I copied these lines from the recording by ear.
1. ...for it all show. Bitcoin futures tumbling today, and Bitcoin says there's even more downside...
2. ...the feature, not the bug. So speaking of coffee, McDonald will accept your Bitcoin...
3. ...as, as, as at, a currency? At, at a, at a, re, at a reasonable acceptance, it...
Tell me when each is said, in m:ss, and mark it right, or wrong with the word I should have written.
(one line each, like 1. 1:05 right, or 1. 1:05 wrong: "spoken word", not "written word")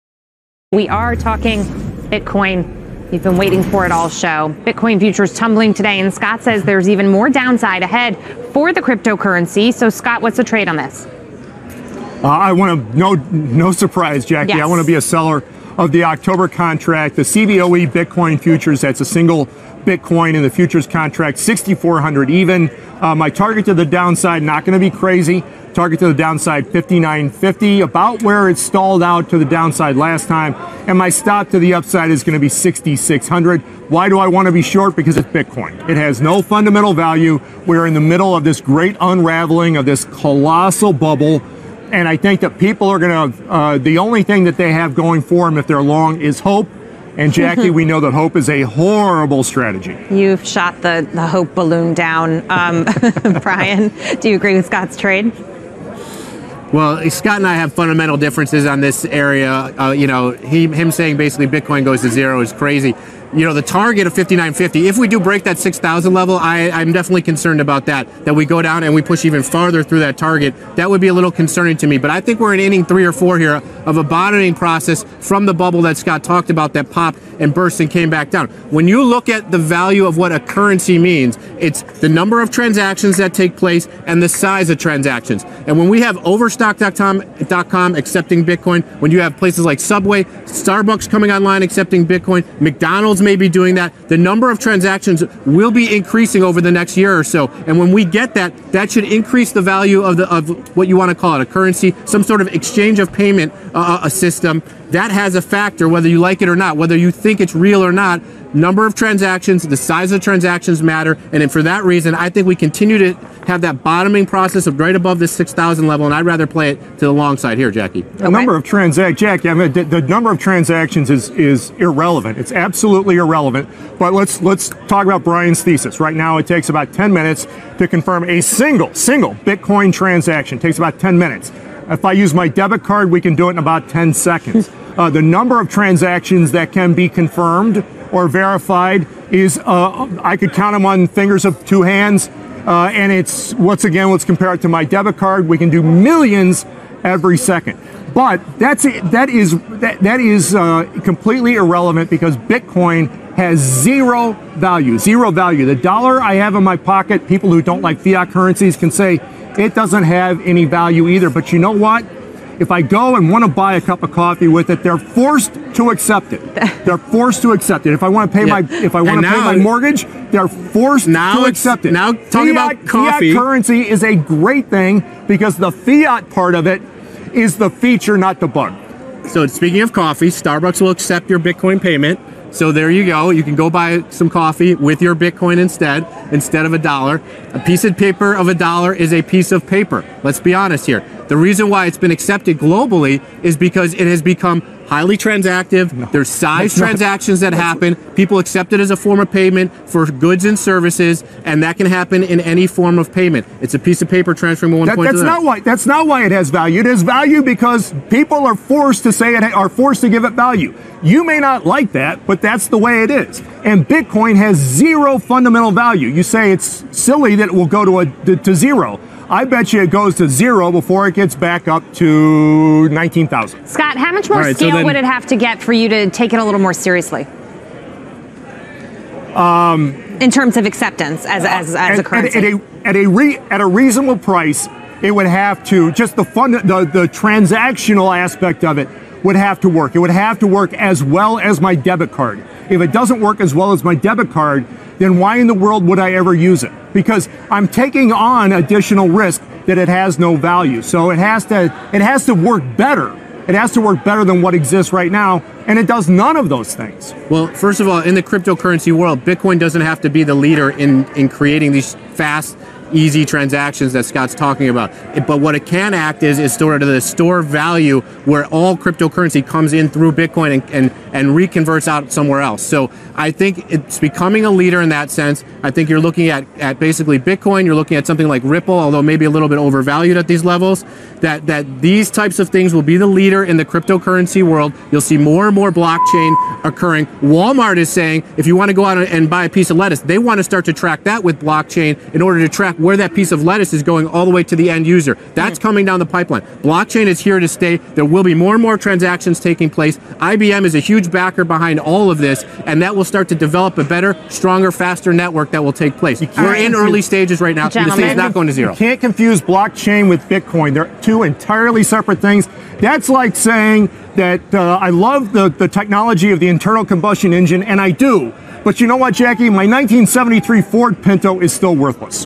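1. 0:03 wrong: "Scott", not "Bitcoin"
2. 2:57 wrong: "Starbucks", not "McDonald"
3. 3:51 wrong: "price", not "acceptance".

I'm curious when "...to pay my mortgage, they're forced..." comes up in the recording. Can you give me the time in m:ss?
2:49.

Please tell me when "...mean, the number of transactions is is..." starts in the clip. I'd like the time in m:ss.
1:59.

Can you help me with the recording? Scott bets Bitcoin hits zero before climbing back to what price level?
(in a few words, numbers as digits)
19,000.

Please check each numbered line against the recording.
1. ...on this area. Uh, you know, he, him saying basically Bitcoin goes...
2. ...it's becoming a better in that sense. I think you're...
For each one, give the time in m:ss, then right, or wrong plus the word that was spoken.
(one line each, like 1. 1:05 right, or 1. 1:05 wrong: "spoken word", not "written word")
1. 0:58 right
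2. 4:33 wrong: "leader", not "better".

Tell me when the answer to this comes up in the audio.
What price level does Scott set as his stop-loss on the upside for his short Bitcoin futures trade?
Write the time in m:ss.
0:32.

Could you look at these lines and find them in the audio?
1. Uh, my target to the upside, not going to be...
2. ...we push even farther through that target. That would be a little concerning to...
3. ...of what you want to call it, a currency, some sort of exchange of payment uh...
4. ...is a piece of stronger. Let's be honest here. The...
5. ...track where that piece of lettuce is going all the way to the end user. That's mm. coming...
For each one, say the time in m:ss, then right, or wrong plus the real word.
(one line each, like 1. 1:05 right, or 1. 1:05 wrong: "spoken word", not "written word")
1. 0:23 wrong: "downside", not "upside"
2. 1:08 right
3. 1:40 right
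4. 3:08 wrong: "paper", not "stronger"
5. 4:52 right.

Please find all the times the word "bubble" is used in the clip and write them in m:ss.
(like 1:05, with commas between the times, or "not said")
0:40, 1:15.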